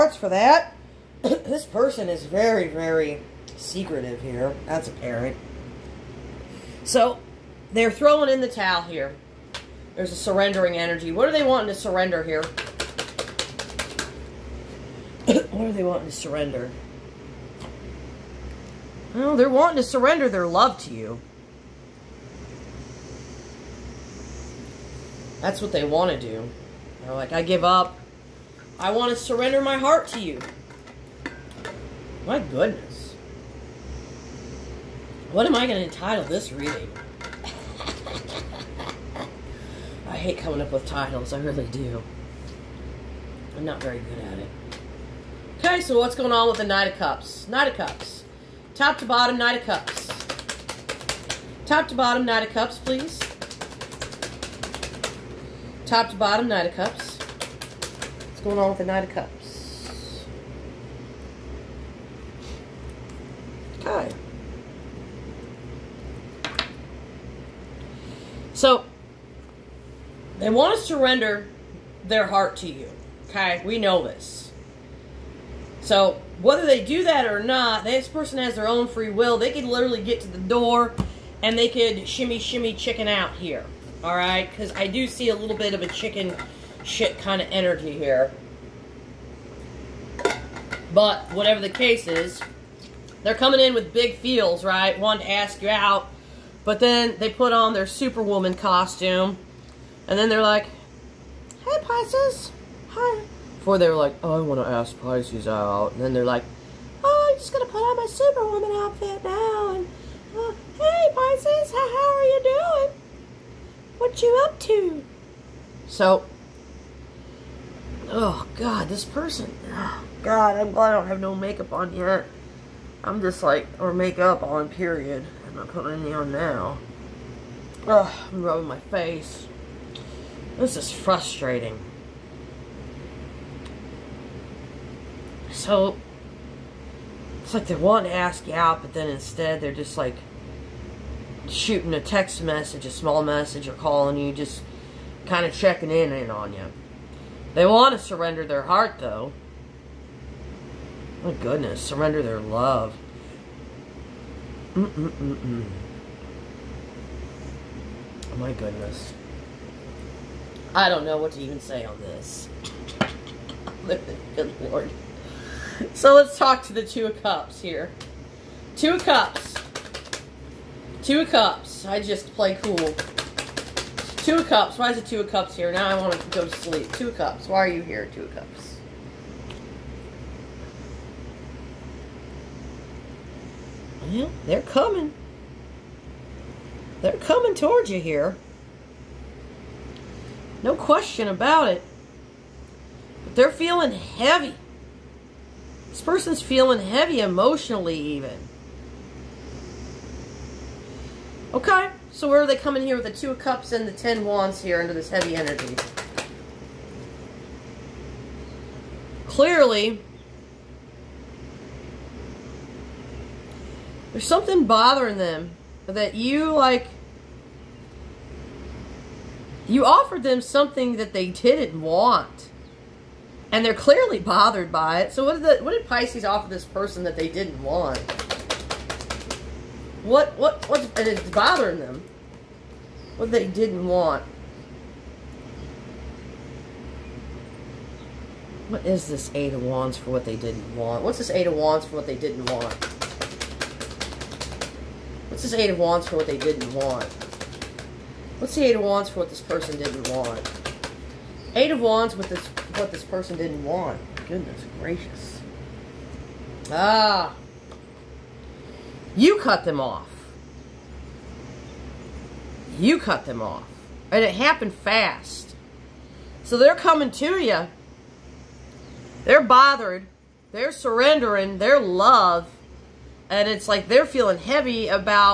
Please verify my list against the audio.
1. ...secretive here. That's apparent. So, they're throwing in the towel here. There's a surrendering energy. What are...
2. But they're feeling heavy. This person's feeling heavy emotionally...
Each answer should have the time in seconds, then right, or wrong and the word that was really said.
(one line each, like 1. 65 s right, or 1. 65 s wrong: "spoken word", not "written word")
1. 3 s right
2. 193 s right.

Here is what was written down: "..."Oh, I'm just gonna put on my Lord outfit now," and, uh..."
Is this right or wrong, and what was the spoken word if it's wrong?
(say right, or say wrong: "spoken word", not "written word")
wrong: "Superwoman", not "Lord".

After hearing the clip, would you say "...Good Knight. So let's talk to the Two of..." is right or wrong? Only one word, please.
wrong.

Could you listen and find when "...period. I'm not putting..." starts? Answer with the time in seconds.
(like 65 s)
124 s.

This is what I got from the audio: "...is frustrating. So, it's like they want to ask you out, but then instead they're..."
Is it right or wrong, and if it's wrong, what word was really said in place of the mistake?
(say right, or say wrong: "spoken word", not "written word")
right.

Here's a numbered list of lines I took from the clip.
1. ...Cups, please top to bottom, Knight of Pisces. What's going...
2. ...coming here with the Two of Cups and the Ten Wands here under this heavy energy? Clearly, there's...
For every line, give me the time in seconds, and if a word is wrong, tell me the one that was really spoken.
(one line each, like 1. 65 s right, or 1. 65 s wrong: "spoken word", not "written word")
1. 52 s wrong: "Cups", not "Pisces"
2. 202 s right.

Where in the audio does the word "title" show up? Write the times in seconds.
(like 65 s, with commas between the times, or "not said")
35 s, 40 s.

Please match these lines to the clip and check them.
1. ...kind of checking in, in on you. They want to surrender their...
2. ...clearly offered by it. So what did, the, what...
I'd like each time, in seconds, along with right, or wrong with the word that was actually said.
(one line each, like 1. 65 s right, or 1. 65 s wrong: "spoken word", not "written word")
1. 145 s right
2. 223 s wrong: "bothered", not "offered".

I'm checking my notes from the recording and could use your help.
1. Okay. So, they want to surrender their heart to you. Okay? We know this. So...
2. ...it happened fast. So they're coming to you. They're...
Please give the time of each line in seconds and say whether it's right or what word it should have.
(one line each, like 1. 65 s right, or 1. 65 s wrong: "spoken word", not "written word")
1. 63 s right
2. 264 s right.